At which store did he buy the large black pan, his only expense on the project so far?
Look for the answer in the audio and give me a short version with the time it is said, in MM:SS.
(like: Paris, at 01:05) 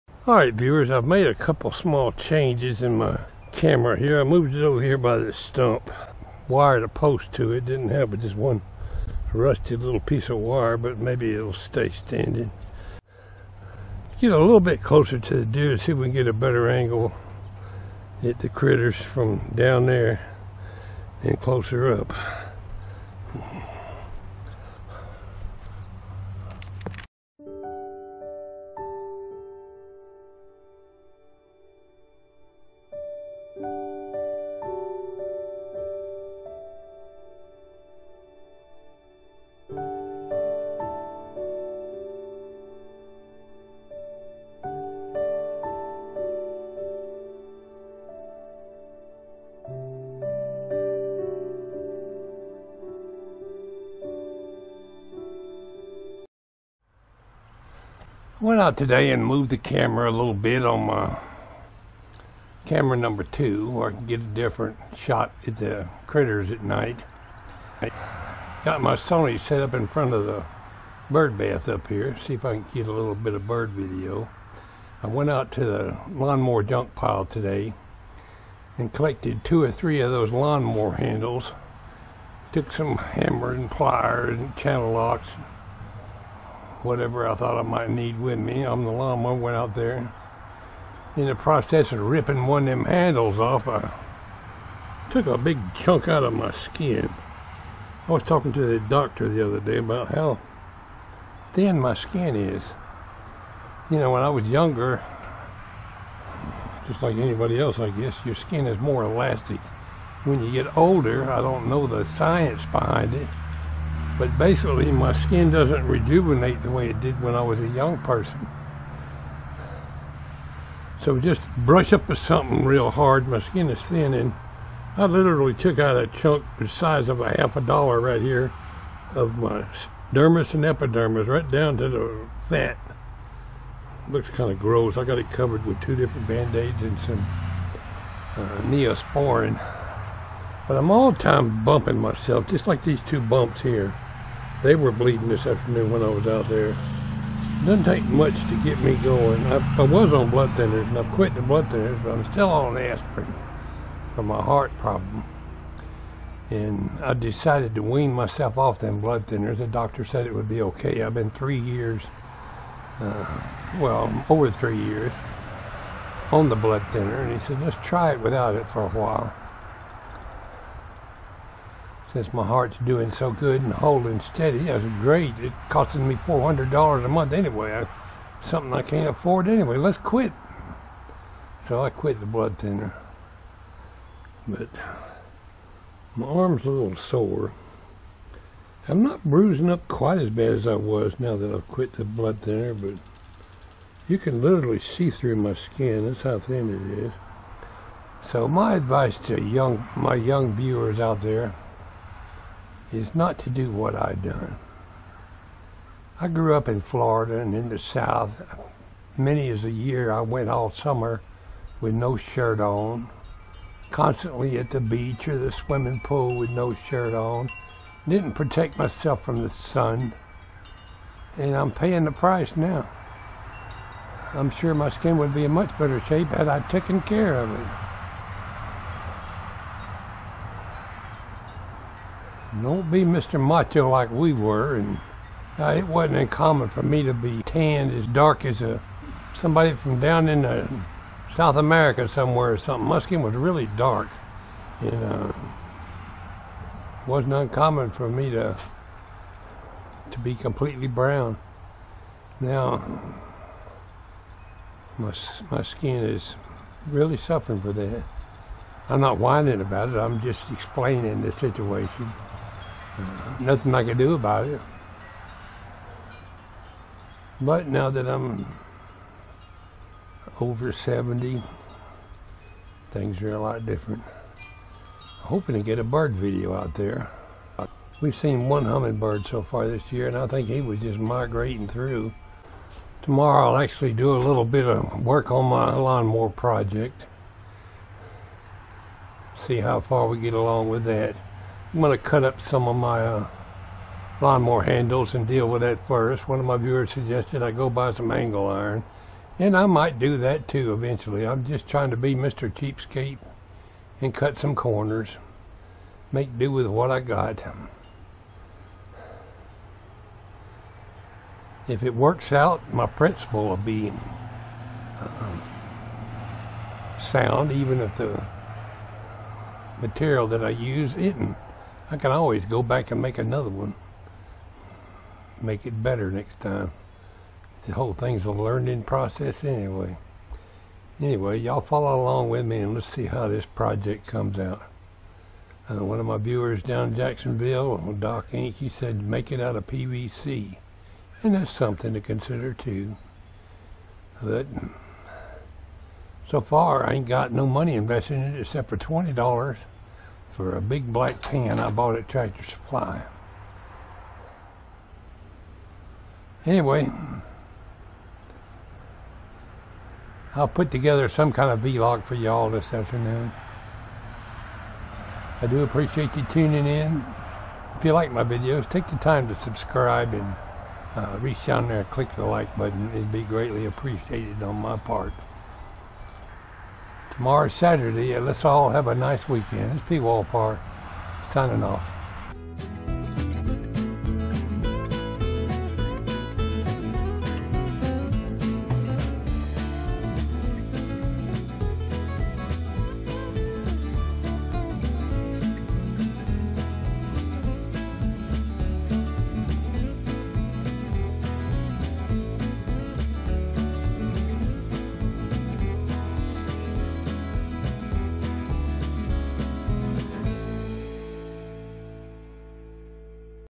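Tractor Supply, at 05:52.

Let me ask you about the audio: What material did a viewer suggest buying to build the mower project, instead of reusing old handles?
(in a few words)
angle iron.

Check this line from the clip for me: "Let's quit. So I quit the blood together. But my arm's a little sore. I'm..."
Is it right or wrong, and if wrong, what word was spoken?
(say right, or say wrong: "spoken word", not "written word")
wrong: "thinner", not "together".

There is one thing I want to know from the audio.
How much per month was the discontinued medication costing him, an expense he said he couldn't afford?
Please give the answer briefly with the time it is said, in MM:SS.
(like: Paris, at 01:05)
$400, at 02:56.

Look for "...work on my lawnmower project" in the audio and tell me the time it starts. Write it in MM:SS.
04:45.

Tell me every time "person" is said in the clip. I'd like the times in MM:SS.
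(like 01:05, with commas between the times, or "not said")
01:57.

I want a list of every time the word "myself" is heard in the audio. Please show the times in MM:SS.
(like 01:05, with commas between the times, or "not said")
02:21, 02:38, 03:38.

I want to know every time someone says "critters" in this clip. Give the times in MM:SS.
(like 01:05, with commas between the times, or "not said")
00:18, 01:06.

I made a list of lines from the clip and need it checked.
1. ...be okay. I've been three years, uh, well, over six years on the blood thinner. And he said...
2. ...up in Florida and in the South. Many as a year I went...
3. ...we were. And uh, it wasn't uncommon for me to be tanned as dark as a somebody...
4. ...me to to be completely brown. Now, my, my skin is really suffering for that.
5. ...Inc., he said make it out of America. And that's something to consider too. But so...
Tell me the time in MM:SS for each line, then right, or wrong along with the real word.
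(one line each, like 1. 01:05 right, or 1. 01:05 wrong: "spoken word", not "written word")
1. 02:40 wrong: "three", not "six"
2. 03:26 right
3. 03:54 right
4. 04:08 right
5. 05:38 wrong: "PVC", not "America".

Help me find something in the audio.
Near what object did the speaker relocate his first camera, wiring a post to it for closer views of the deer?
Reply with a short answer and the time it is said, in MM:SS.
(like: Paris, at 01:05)
stump, at 00:05.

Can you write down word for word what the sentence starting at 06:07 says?
If you like my videos, take the time to subscribe and uh, reach down there and click the like button.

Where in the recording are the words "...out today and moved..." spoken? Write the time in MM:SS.
00:58.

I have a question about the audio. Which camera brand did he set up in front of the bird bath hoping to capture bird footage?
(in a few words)
Sony.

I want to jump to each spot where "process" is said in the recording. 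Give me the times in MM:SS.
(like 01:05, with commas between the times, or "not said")
01:31, 05:28.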